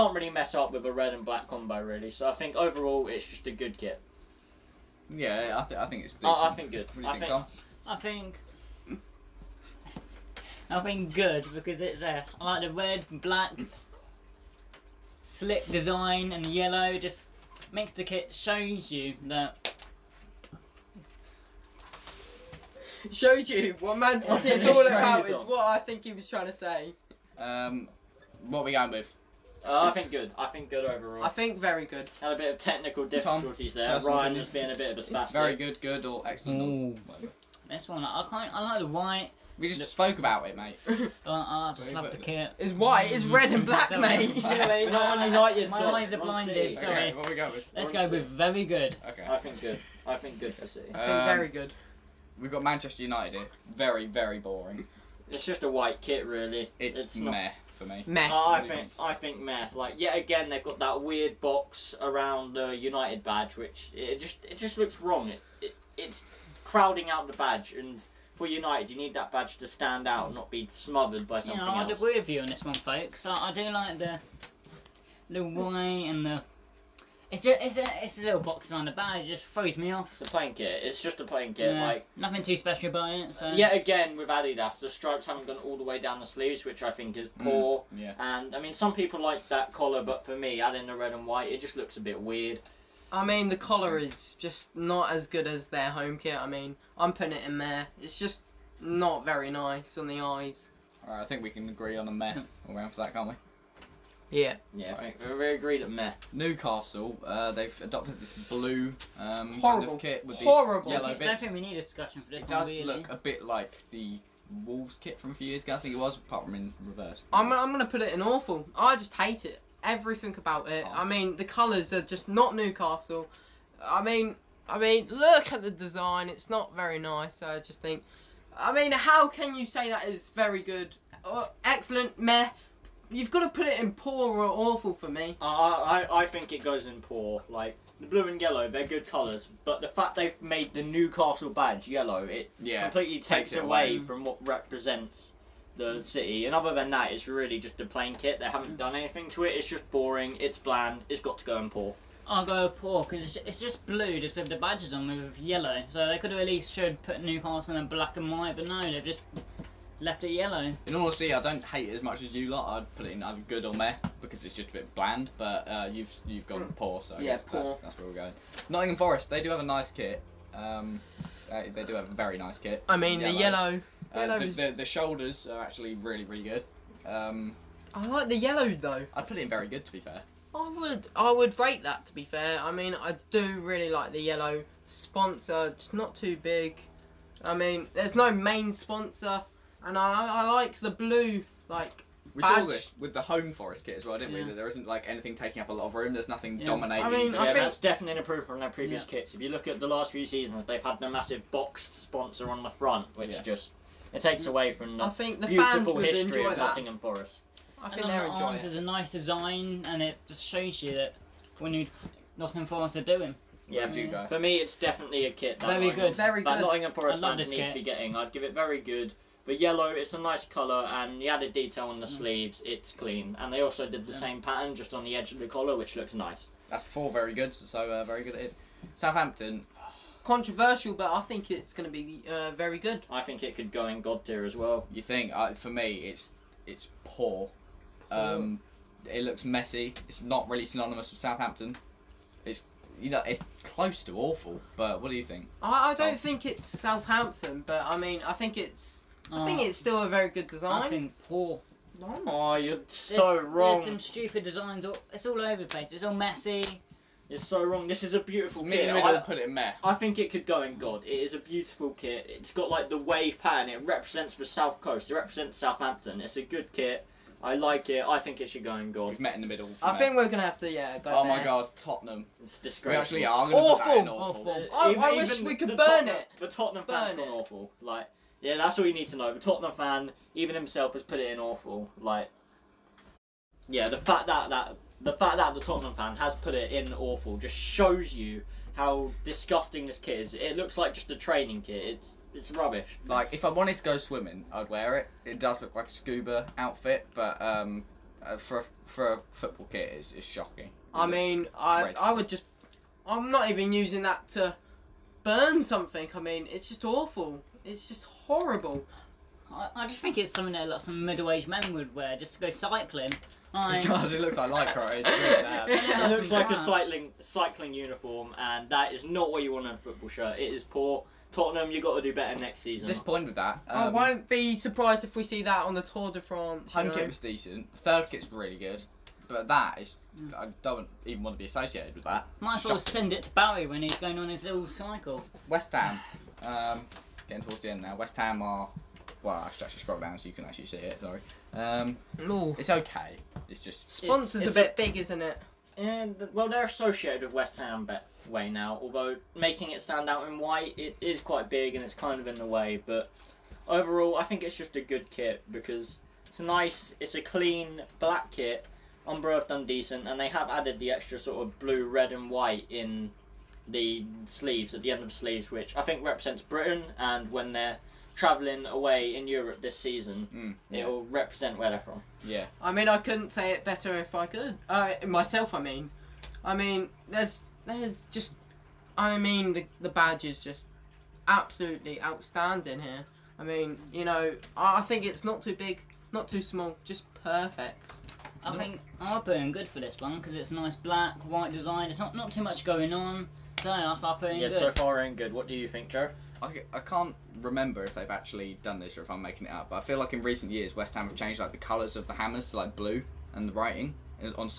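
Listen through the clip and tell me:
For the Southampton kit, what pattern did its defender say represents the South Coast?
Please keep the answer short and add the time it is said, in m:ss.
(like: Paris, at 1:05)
wave pattern, at 4:22.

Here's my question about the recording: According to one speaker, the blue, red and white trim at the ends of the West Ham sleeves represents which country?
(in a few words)
Britain.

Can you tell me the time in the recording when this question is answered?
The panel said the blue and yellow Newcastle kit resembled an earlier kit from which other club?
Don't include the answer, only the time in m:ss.
1:54.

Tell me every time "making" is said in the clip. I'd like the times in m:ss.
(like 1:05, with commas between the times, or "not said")
5:49, 6:39.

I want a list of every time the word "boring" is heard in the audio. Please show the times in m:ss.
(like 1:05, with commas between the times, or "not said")
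0:54, 2:29.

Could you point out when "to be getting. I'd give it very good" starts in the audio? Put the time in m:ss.
3:37.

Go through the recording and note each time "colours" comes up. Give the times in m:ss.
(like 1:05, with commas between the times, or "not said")
2:01, 2:19, 3:40, 6:41.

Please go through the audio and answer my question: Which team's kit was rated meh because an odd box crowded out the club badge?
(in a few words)
Manchester United.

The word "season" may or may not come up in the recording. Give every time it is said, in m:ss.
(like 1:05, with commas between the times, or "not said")
3:20, 5:22, 6:09.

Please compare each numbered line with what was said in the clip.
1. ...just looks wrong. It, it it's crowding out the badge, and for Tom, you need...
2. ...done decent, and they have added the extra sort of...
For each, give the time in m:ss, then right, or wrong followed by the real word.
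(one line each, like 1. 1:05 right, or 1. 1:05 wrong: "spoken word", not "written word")
1. 1:04 wrong: "United", not "Tom"
2. 5:59 right.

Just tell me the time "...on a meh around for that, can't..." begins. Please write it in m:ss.
1:41.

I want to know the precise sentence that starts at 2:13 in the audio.
You've got to put it in poor or awful for me.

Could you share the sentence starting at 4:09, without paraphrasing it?
it's still a very good design.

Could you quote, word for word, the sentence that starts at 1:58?
I just hate it everything about it.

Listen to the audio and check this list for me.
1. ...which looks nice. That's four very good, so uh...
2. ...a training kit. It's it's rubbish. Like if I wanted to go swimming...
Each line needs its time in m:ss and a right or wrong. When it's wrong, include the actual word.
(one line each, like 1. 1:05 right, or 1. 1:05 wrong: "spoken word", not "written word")
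1. 3:45 right
2. 4:51 right.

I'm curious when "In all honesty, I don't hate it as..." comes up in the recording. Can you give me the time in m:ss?
2:40.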